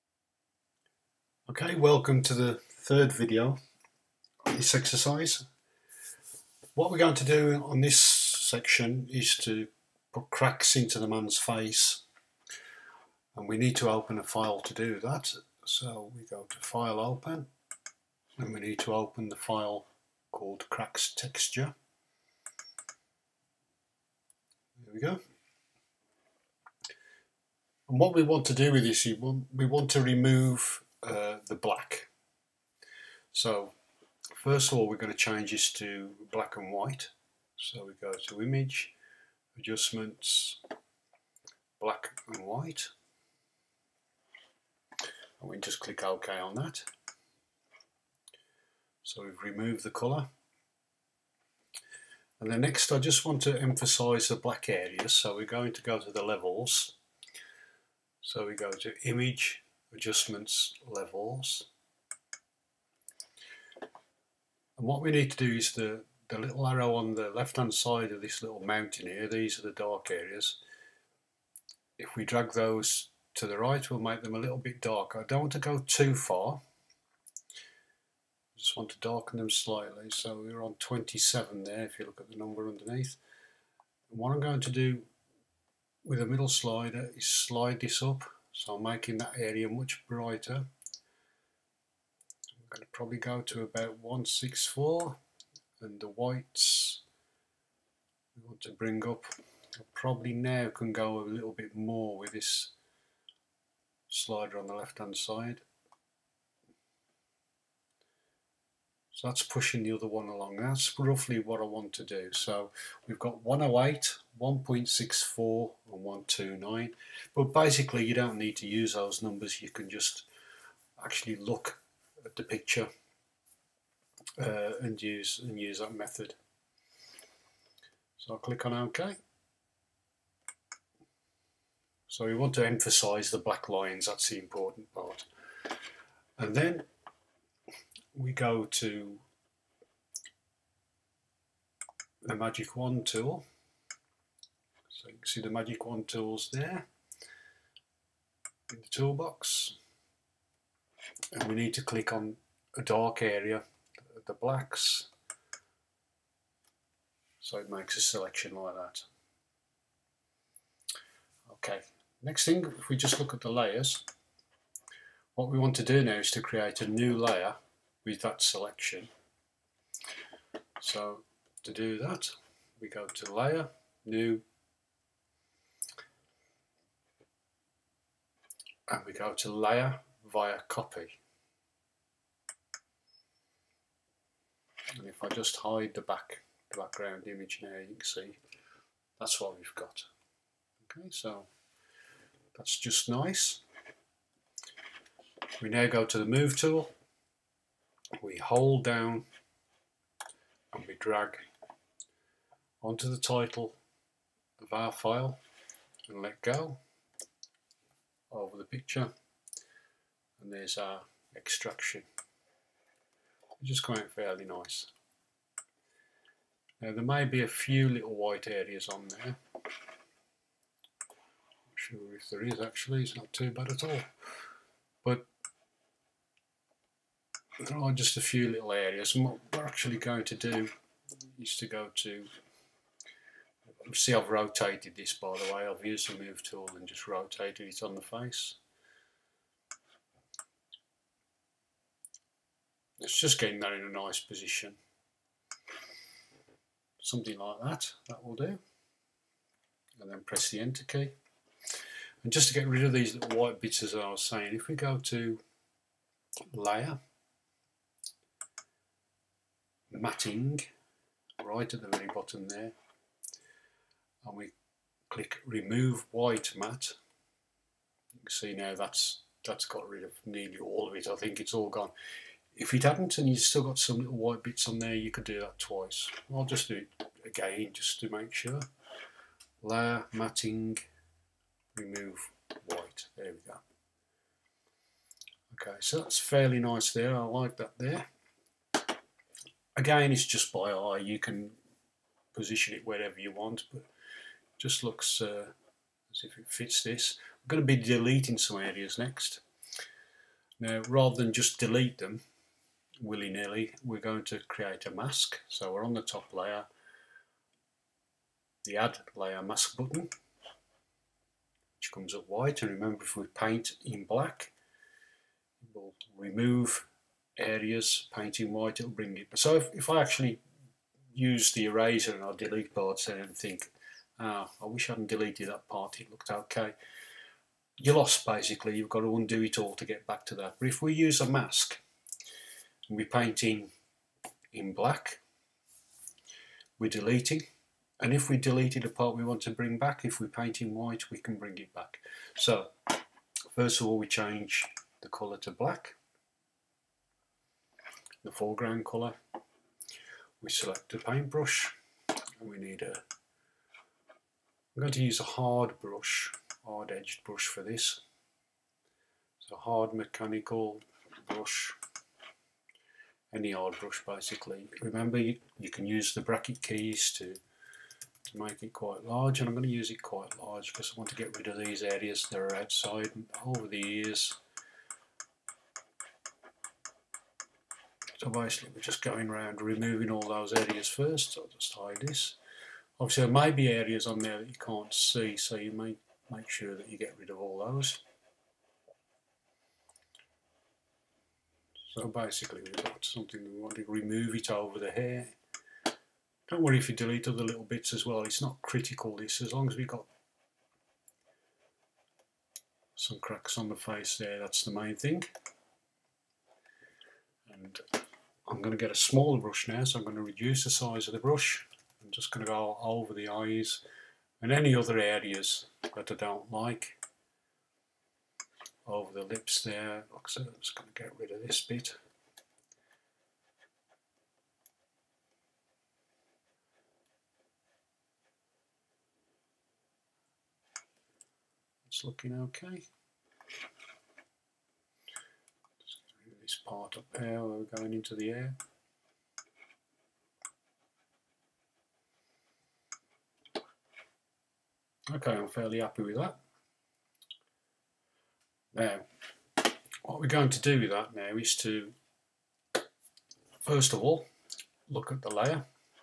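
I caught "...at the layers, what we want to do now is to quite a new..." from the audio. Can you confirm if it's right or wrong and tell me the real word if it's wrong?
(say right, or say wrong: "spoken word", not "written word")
wrong: "create", not "quite".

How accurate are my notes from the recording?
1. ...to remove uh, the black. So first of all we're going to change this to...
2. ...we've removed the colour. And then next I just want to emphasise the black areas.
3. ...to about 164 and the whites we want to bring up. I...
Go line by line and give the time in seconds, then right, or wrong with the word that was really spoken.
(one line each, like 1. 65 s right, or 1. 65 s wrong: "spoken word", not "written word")
1. 29 s right
2. 49 s right
3. 93 s right.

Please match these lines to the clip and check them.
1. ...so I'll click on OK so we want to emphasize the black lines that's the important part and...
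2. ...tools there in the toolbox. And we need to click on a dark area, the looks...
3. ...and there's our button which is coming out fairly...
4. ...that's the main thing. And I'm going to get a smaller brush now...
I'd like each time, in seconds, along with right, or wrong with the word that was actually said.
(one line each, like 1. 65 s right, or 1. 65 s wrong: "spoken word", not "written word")
1. 128 s right
2. 146 s wrong: "blacks", not "looks"
3. 210 s wrong: "extraction", not "button"
4. 404 s right.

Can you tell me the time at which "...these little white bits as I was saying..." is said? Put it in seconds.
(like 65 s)
252 s.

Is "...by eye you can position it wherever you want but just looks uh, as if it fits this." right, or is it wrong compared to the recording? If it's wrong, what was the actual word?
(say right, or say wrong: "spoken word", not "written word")
right.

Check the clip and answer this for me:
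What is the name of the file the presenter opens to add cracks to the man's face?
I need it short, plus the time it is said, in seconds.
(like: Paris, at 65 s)
Cracks Texture, at 20 s.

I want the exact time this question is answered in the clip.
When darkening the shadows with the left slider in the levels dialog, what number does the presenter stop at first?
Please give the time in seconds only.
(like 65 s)
80 s.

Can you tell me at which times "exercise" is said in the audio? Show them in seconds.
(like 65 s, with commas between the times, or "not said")
4 s.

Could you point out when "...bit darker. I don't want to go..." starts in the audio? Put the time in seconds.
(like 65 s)
74 s.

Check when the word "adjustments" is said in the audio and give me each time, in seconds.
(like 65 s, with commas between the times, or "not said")
39 s, 59 s.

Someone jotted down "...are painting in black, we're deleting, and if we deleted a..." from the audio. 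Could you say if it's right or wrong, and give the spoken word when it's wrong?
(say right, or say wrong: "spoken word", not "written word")
right.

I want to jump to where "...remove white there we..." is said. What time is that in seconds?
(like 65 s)
281 s.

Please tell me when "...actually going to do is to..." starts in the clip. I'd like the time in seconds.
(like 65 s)
229 s.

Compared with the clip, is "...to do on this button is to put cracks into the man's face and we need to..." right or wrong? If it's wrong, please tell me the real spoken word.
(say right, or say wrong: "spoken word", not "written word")
wrong: "section", not "button".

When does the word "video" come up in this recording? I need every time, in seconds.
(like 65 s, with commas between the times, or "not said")
3 s.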